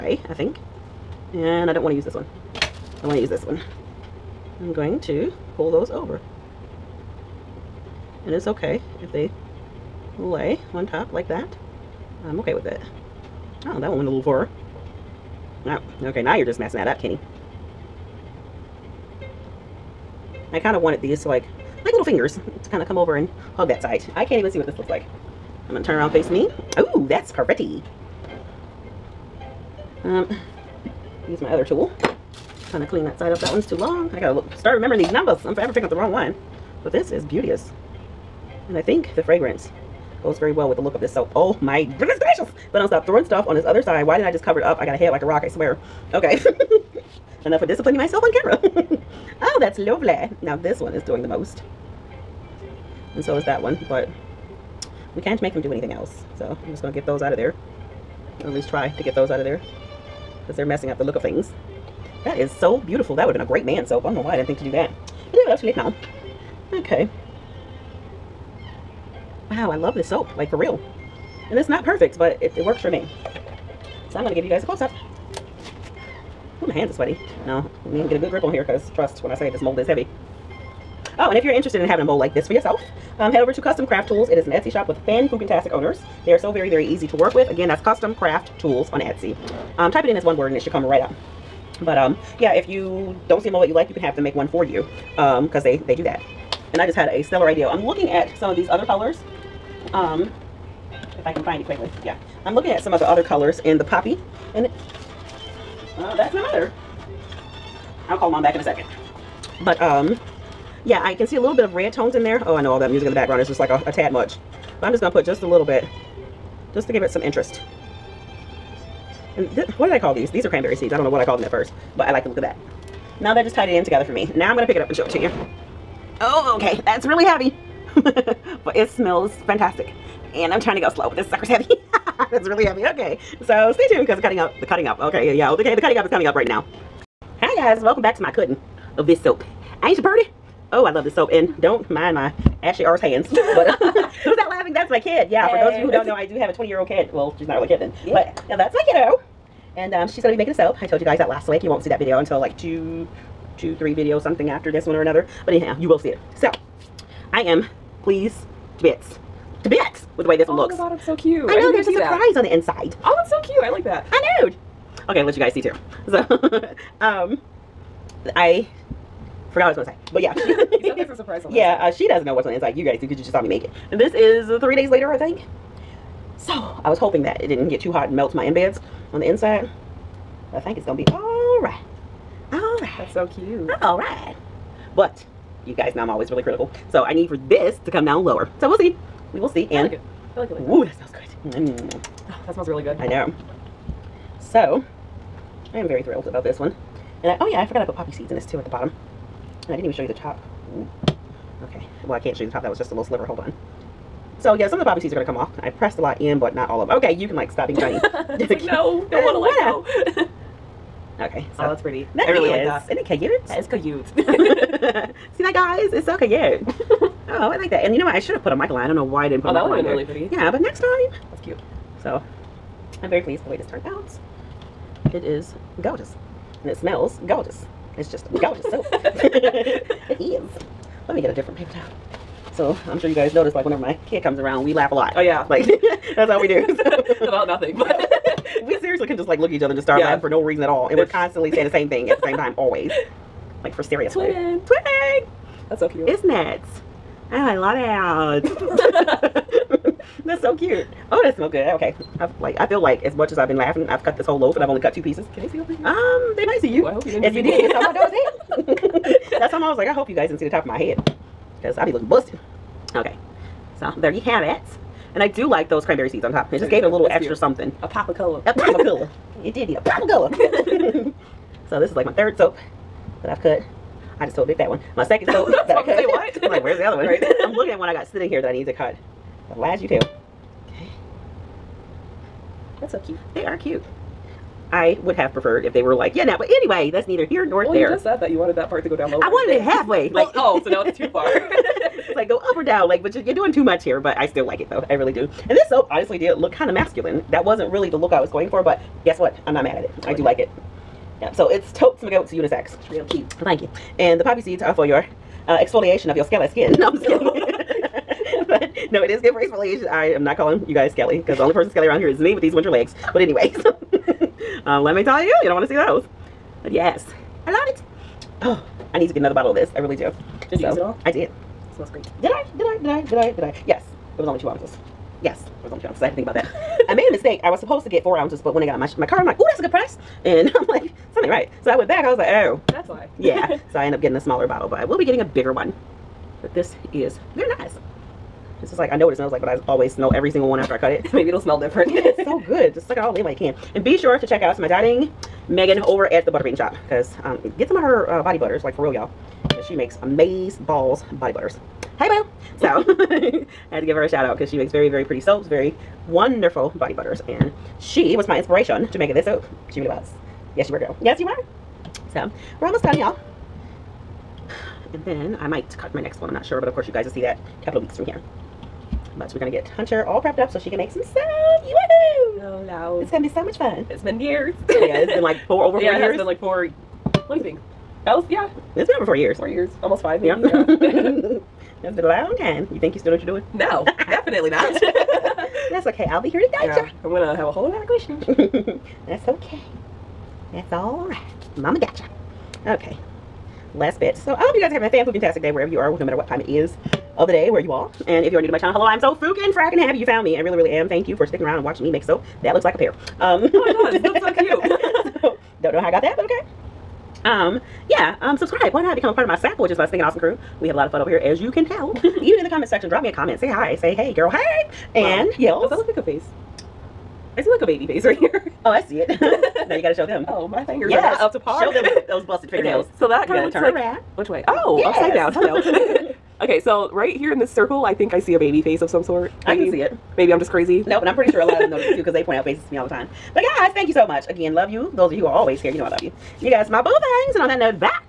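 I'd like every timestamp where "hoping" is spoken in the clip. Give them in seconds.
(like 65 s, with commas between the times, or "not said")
176 s.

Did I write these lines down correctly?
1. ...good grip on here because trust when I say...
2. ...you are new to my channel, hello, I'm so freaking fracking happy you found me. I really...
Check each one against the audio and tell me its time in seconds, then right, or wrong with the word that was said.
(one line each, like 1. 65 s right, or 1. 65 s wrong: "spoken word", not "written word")
1. 78 s right
2. 398 s right.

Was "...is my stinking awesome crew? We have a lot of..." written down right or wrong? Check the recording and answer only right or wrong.
right.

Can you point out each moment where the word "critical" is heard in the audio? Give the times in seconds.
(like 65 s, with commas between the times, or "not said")
186 s.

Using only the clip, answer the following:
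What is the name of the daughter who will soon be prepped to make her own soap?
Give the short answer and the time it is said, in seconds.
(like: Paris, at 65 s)
Hunter, at 369 s.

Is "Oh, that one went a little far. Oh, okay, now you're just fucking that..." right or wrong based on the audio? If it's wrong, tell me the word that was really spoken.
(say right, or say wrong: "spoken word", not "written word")
wrong: "messing", not "fucking".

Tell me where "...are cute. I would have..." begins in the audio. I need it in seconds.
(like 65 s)
283 s.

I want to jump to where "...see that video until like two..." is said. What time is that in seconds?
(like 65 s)
151 s.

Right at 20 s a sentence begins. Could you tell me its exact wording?
I kind of wanted these to like, like little fingers to kind of come over and hug that side.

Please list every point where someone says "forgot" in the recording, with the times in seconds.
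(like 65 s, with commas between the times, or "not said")
169 s, 197 s.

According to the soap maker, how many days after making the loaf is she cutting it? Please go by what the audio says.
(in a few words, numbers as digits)
3.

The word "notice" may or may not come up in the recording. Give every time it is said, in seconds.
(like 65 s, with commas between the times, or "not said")
233 s, 431 s.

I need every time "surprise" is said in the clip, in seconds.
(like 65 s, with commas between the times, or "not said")
161 s, 171 s.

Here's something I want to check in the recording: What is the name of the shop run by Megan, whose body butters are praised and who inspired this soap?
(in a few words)
the Butter Shop.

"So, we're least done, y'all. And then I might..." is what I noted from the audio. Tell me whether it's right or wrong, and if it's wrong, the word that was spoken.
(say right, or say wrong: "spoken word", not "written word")
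wrong: "almost", not "least".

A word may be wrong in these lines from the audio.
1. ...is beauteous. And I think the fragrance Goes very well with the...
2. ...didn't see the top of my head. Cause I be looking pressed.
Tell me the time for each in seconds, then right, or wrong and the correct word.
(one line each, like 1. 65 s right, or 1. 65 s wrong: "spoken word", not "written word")
1. 37 s right
2. 260 s wrong: "busted", not "pressed".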